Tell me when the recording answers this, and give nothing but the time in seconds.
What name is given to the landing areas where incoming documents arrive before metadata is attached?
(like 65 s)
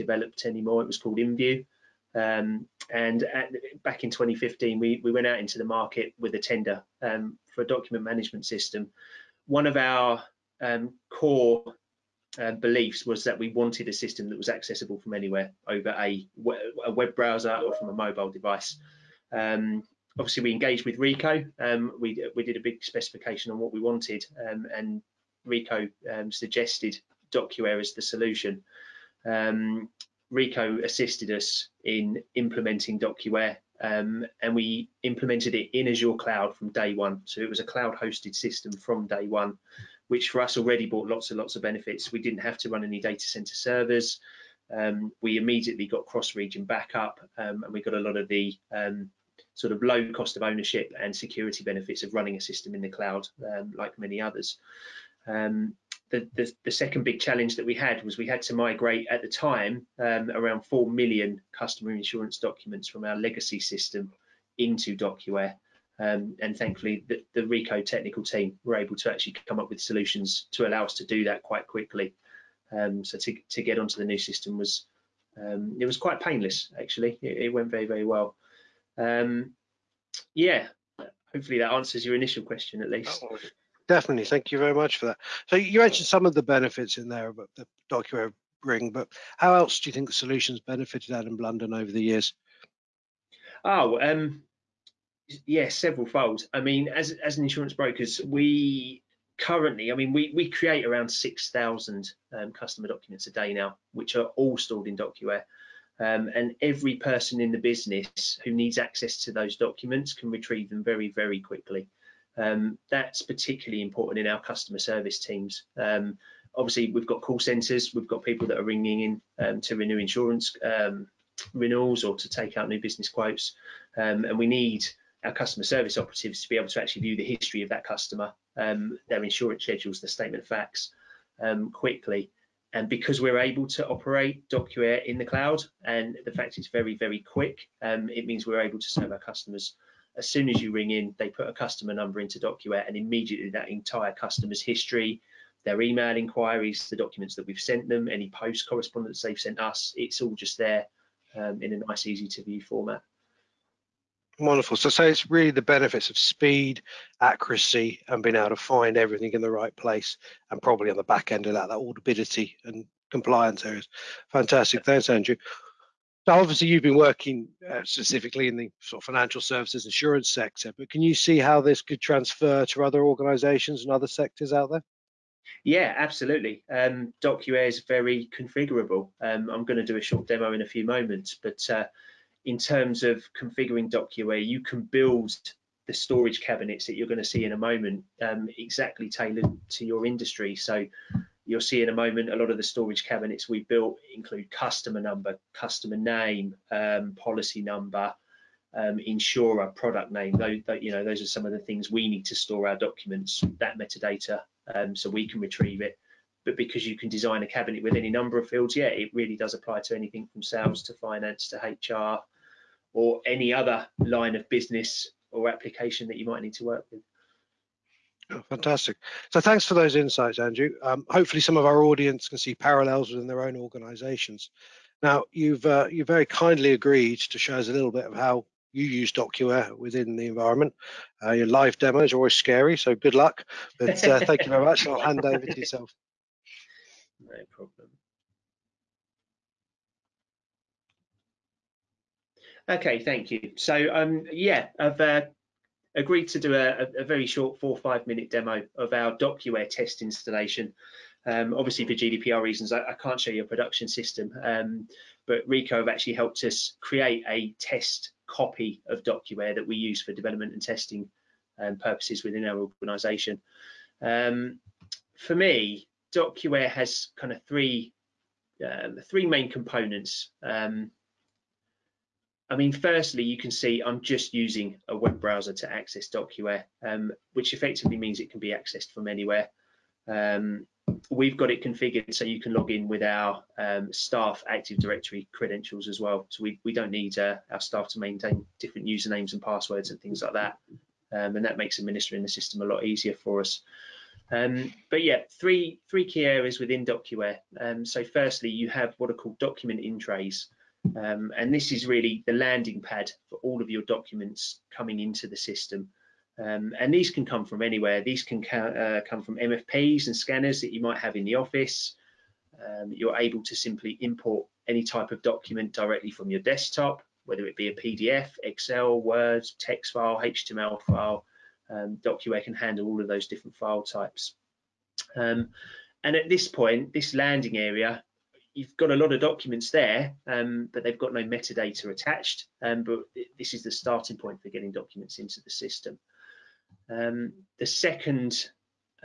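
299 s.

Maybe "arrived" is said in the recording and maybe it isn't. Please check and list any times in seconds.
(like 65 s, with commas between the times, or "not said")
not said.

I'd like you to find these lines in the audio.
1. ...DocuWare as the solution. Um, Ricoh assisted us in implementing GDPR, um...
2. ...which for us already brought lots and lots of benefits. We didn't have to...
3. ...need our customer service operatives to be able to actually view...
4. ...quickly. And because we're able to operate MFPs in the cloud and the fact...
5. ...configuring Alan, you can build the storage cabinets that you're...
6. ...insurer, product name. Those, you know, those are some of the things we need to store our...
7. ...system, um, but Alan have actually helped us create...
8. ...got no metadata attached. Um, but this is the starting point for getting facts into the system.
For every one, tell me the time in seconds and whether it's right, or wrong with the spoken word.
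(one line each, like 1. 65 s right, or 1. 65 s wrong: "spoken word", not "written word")
1. 27 s wrong: "DocuWare", not "GDPR"
2. 40 s right
3. 124 s right
4. 131 s wrong: "DocuWare", not "MFPs"
5. 183 s wrong: "DocuWare", not "Alan"
6. 198 s right
7. 253 s wrong: "Ricoh", not "Alan"
8. 330 s wrong: "documents", not "facts".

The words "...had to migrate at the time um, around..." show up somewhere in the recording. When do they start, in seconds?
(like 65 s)
58 s.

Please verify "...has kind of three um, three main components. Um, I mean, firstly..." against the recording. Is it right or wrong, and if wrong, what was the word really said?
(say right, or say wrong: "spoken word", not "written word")
right.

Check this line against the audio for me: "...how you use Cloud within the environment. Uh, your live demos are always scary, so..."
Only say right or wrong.
wrong.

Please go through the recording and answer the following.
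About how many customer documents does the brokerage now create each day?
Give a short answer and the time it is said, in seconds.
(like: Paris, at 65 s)
6000, at 101 s.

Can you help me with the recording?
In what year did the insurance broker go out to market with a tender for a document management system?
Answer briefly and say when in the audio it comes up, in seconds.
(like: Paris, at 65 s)
2015, at 4 s.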